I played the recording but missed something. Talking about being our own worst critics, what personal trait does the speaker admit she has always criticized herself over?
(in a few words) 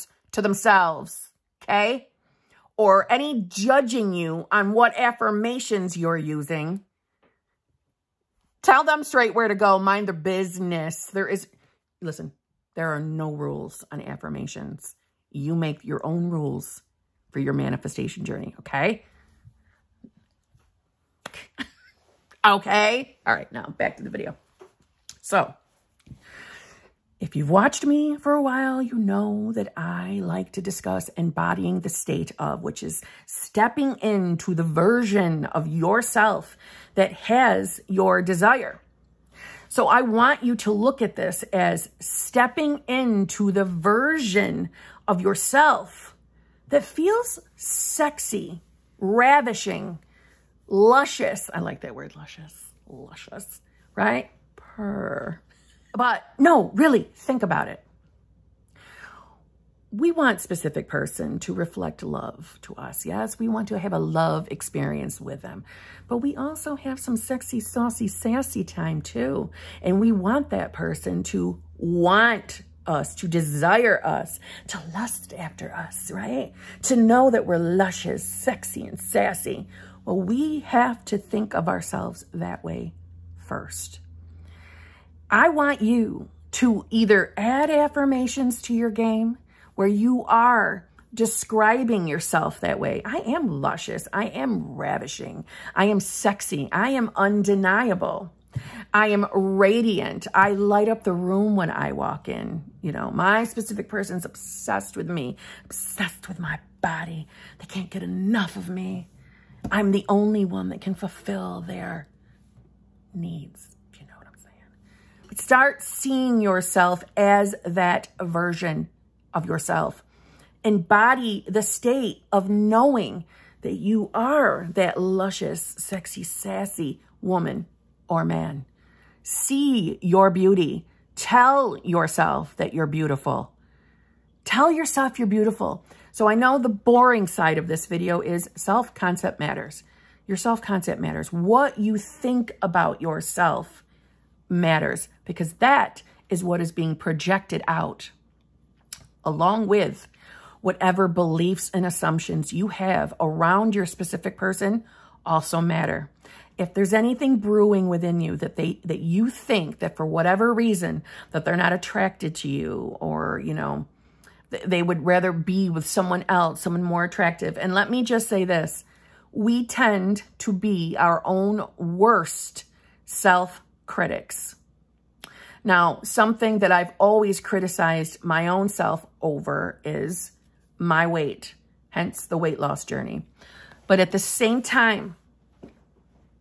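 my weight.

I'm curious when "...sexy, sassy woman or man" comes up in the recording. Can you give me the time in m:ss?
2:05.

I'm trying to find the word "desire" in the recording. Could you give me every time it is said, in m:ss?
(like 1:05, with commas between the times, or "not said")
0:38, 1:13.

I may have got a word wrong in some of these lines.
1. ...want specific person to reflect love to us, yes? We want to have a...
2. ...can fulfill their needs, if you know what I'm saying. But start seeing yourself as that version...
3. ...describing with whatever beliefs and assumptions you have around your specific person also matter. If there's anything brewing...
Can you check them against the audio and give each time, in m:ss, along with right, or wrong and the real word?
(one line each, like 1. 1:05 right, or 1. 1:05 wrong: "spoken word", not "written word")
1. 1:00 right
2. 1:50 right
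3. 2:29 wrong: "along", not "describing".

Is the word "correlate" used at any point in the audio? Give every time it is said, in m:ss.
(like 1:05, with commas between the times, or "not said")
not said.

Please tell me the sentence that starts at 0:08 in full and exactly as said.
Tell them straight where to go.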